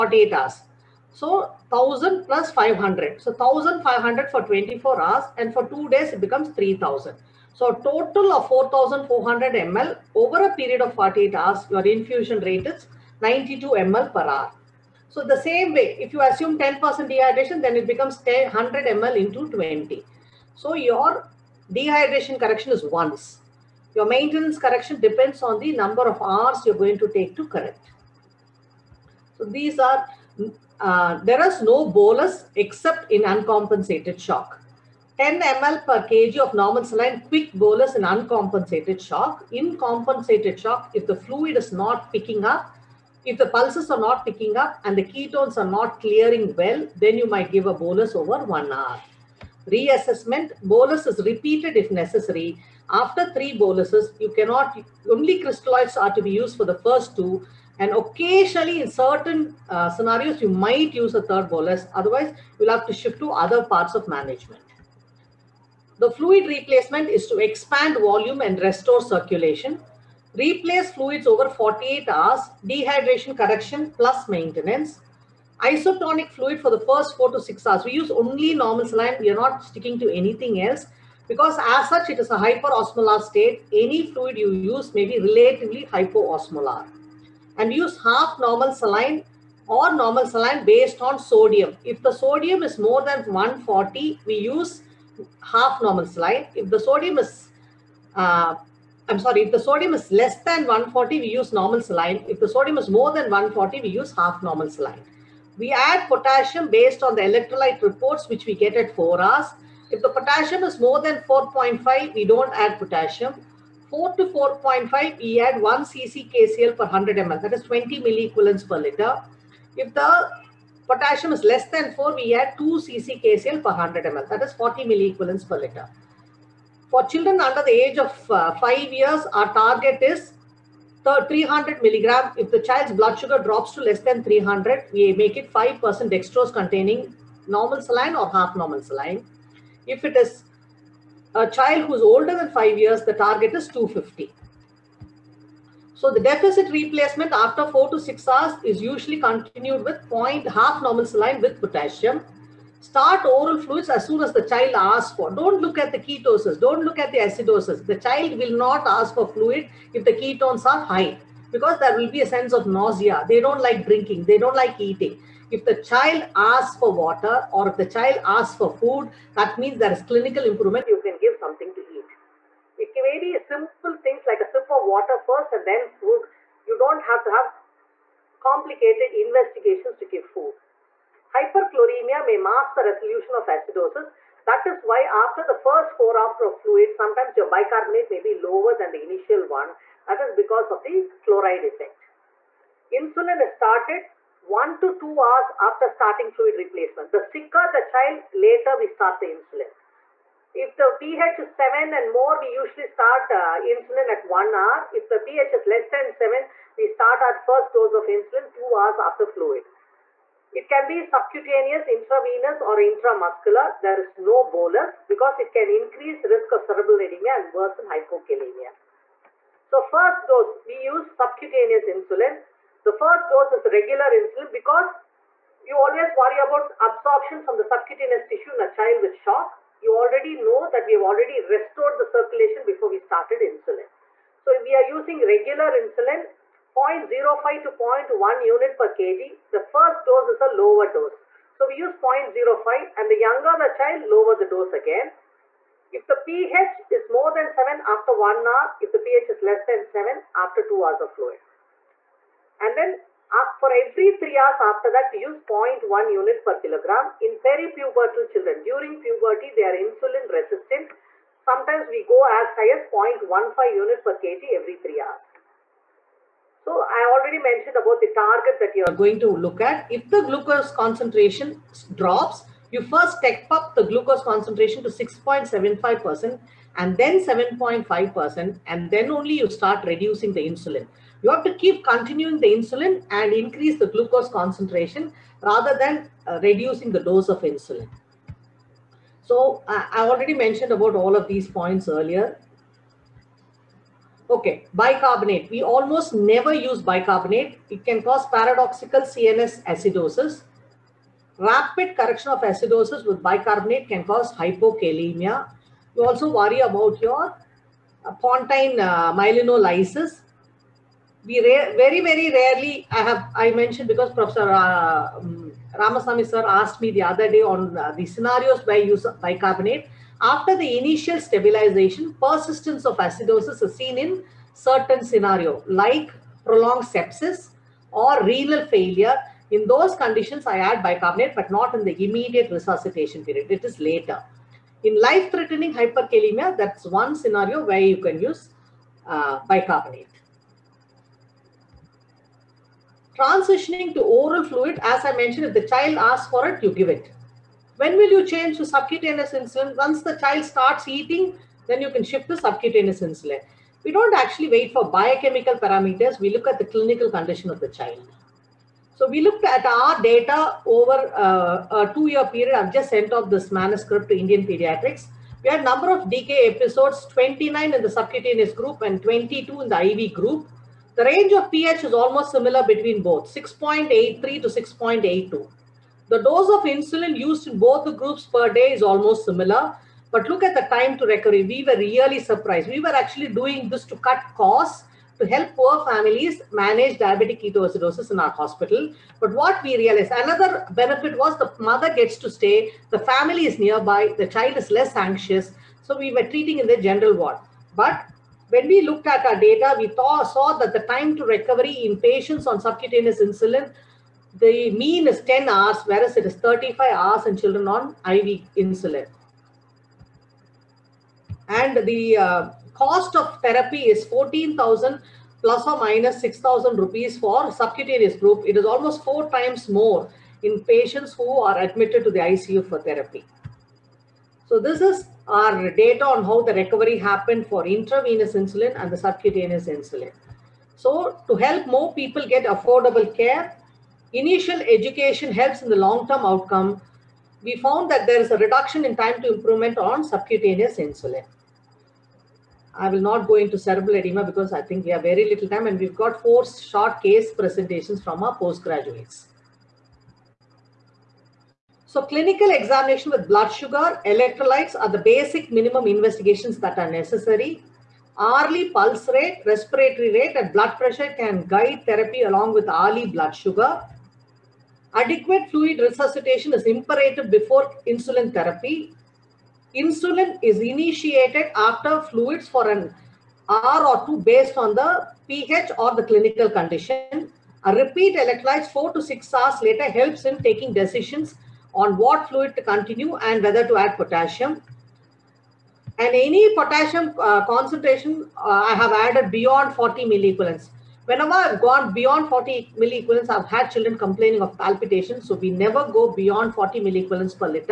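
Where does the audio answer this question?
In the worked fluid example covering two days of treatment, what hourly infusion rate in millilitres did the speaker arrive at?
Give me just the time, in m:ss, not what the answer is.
0:13.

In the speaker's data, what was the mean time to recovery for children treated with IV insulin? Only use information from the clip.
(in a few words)
35 hours.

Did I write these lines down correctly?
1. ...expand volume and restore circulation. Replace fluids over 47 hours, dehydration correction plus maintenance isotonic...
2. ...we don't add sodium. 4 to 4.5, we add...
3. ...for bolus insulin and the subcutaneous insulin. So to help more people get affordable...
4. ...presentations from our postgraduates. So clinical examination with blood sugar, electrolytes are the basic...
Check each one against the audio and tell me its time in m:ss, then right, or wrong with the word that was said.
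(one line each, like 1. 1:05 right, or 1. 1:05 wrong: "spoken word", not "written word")
1. 1:07 wrong: "48", not "47"
2. 1:52 wrong: "potassium", not "sodium"
3. 7:07 wrong: "intravenous", not "bolus"
4. 7:27 right.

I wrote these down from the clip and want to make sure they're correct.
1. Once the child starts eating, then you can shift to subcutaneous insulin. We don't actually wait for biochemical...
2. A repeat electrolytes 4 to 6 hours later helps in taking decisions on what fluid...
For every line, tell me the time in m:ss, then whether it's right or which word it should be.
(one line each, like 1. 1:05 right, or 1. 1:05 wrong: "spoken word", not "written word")
1. 5:49 right
2. 7:57 right.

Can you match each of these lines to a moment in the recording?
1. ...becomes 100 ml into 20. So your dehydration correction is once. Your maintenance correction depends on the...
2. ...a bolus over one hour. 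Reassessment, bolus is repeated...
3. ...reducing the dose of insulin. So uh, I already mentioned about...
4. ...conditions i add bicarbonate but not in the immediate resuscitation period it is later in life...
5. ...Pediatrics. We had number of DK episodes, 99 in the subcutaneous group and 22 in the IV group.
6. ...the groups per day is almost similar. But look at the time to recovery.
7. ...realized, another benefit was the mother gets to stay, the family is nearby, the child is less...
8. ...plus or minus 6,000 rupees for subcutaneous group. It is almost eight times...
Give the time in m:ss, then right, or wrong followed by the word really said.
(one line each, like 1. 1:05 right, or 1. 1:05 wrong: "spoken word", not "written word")
1. 0:17 right
2. 0:47 right
3. 4:46 right
4. 5:30 right
5. 6:04 wrong: "29", not "99"
6. 6:17 right
7. 6:29 right
8. 6:55 wrong: "four", not "eight".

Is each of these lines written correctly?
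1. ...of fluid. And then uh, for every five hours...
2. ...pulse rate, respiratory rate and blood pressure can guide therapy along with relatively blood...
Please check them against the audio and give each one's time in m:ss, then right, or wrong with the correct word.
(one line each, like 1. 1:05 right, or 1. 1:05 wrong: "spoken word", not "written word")
1. 4:11 wrong: "three", not "five"
2. 7:38 wrong: "hourly", not "relatively".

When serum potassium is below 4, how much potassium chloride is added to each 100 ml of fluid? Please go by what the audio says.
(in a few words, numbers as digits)
2 cc.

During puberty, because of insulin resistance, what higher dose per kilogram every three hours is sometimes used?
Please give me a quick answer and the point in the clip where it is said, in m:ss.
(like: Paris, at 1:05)
0.15 unit per kg, at 4:22.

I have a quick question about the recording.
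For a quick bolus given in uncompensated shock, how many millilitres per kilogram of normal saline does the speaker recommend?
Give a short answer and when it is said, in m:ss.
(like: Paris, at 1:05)
10 ml per kg, at 0:35.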